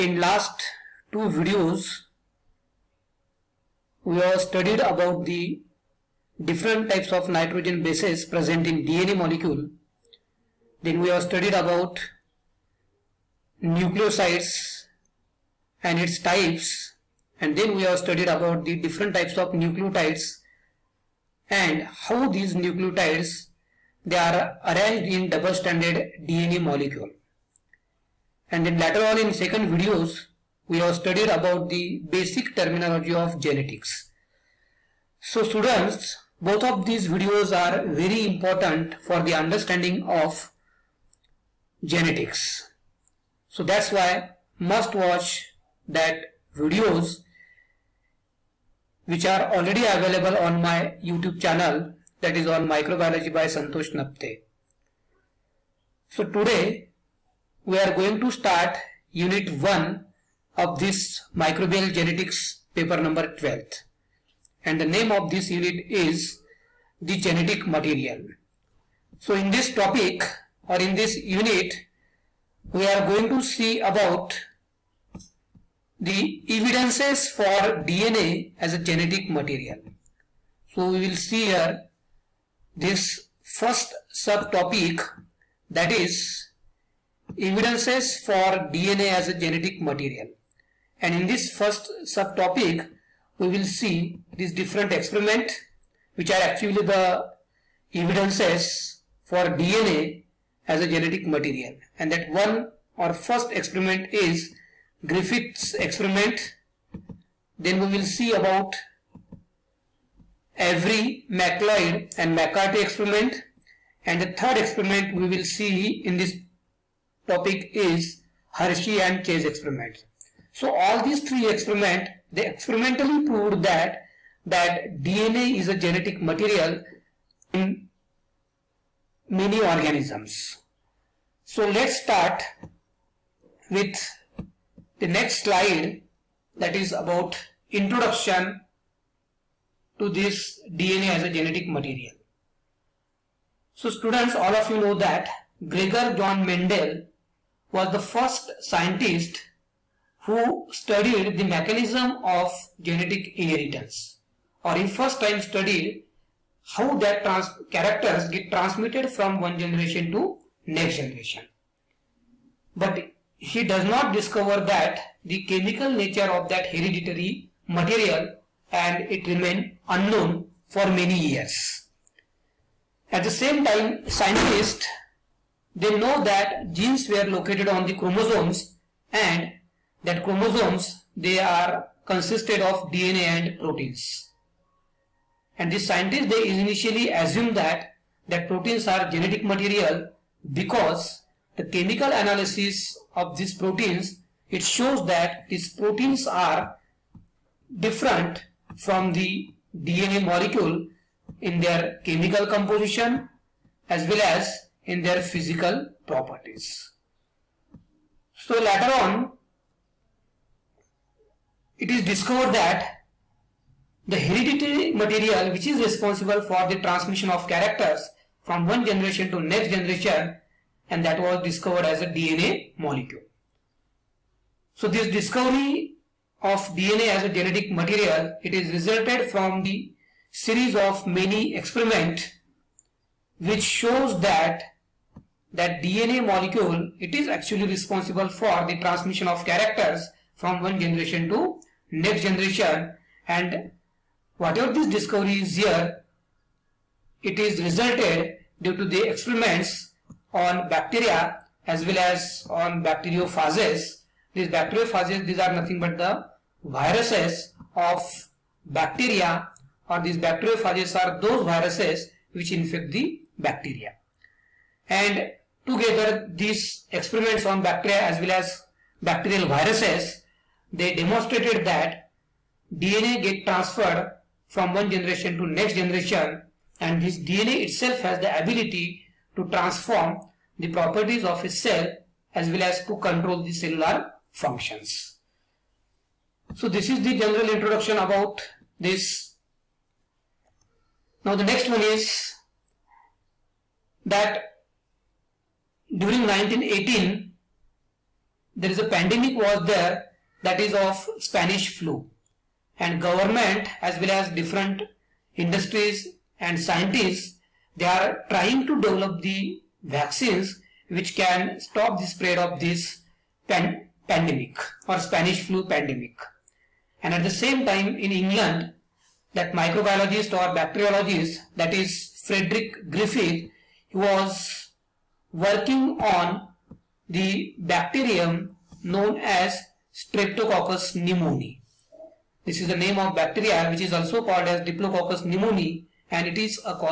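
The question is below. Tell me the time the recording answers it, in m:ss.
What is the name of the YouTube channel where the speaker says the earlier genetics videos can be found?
0:52.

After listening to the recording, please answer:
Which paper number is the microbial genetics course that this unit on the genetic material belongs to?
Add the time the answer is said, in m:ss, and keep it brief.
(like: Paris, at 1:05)
12, at 1:02.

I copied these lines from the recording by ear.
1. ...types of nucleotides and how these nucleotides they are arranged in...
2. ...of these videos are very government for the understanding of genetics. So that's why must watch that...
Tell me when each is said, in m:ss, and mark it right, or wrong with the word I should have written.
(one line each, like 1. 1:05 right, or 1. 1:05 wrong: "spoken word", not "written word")
1. 0:19 right
2. 0:36 wrong: "important", not "government".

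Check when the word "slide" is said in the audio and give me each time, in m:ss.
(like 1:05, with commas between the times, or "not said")
2:15.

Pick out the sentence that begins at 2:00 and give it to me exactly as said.
So all these three experiments they experimentally proved that that DNA is a genetic material in many organisms.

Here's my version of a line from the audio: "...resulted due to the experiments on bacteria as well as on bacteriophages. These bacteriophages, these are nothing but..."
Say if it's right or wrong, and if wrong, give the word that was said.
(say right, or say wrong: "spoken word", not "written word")
right.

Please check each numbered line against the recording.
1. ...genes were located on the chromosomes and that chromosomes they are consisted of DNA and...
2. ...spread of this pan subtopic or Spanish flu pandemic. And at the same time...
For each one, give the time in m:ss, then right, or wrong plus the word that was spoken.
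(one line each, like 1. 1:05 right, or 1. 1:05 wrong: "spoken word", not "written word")
1. 2:56 right
2. 5:12 wrong: "pandemic", not "subtopic".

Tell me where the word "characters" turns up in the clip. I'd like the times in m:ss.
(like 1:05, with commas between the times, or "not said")
2:37, 3:37, 3:59.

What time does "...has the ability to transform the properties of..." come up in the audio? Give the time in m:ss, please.
4:38.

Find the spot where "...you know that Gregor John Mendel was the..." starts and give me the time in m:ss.
2:24.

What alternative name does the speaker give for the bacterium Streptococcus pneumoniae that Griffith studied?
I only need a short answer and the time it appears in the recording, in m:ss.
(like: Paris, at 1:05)
Diplococcus pneumoniae, at 5:34.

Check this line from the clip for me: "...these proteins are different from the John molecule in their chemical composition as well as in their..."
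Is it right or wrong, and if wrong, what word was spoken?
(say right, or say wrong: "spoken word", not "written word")
wrong: "DNA", not "John".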